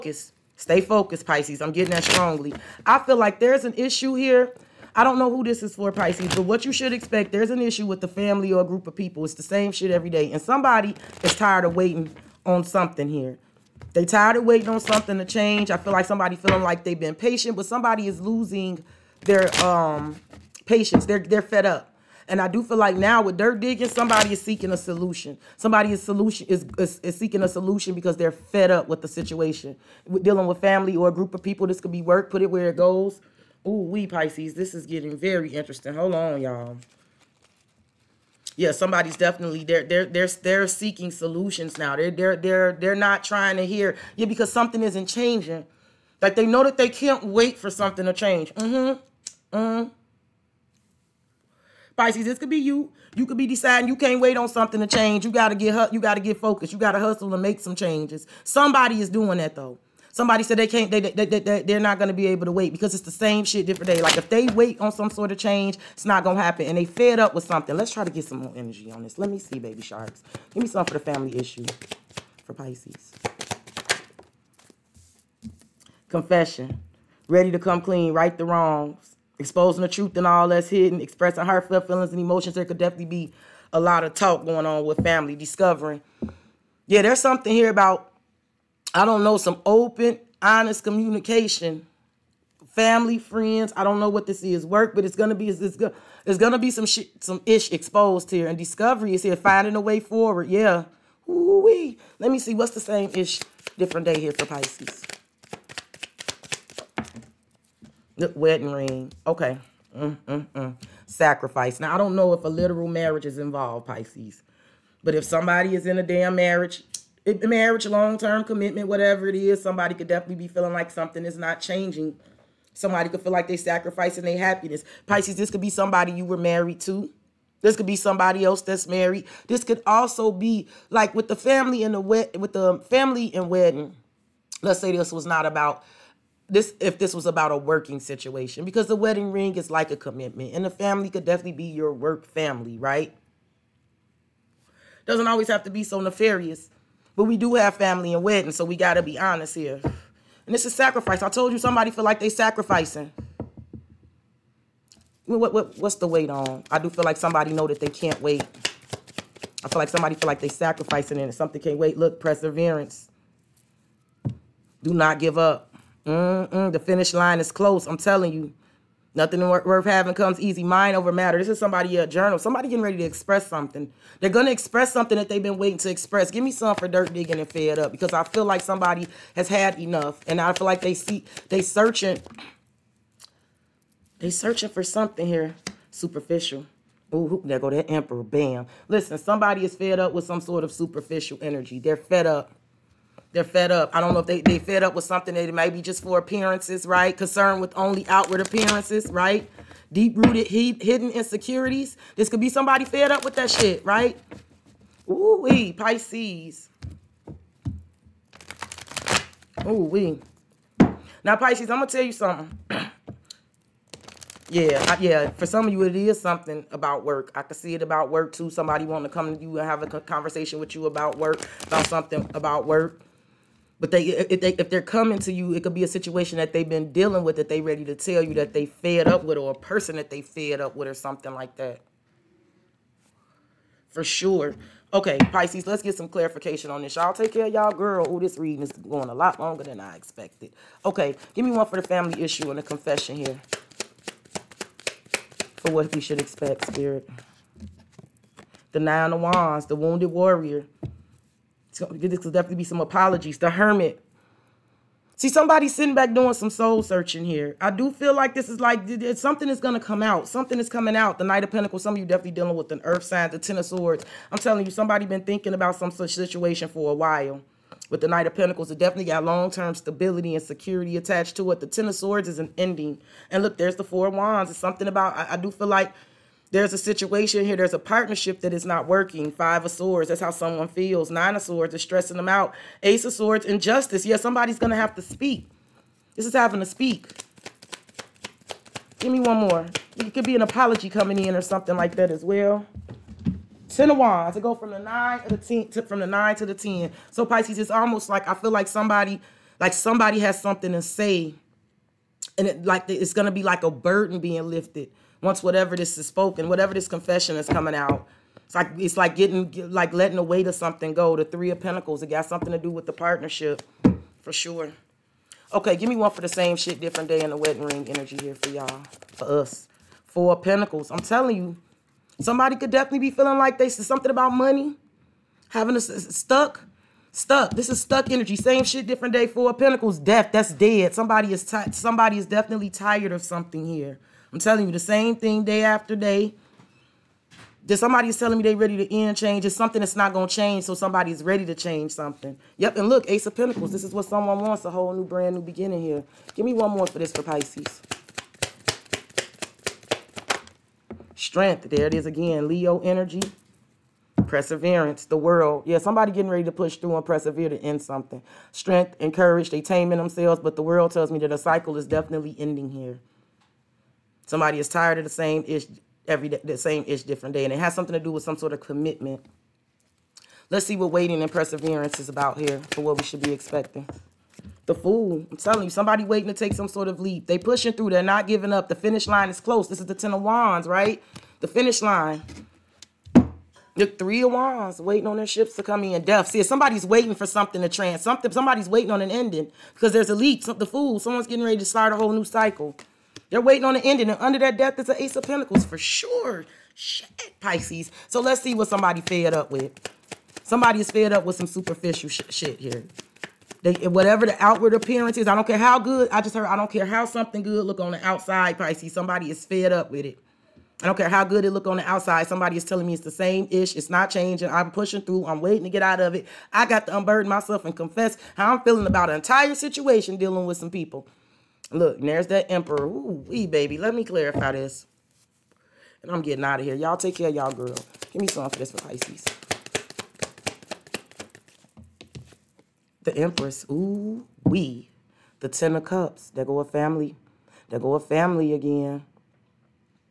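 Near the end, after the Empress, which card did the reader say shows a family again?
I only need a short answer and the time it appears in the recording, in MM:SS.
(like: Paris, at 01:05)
Ten of Cups, at 07:15.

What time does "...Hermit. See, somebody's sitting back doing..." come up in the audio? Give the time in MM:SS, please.
04:13.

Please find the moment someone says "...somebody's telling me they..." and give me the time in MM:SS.
05:37.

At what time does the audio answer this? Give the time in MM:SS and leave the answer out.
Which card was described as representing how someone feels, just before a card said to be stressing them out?
04:39.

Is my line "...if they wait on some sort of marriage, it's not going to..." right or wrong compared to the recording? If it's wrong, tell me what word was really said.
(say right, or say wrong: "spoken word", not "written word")
wrong: "change", not "marriage".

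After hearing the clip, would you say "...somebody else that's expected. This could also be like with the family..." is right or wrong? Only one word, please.
wrong.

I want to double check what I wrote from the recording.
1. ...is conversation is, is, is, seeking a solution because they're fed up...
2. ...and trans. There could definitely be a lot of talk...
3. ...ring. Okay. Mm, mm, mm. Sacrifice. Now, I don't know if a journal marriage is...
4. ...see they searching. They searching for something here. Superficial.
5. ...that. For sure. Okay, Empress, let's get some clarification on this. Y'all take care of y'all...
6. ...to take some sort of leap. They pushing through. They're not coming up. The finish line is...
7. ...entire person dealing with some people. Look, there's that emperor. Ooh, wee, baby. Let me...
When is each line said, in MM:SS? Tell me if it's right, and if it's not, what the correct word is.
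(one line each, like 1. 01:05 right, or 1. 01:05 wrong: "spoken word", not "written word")
1. 00:25 wrong: "solution", not "conversation"
2. 01:22 wrong: "emotions", not "trans"
3. 01:48 wrong: "literal", not "journal"
4. 03:00 right
5. 03:51 wrong: "Pisces", not "Empress"
6. 06:16 wrong: "giving", not "coming"
7. 06:59 wrong: "situation", not "person".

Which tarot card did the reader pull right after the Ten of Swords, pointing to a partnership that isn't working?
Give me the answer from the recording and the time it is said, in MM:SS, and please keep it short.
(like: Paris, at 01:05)
Four of Wands, at 04:33.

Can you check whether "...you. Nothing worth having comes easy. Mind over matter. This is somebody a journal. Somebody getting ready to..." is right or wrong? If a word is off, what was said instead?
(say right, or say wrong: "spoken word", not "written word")
right.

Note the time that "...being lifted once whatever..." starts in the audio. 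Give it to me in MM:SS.
05:04.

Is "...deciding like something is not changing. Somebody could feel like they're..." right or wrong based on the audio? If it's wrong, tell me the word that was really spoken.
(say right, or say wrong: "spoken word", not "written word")
wrong: "feeling", not "deciding".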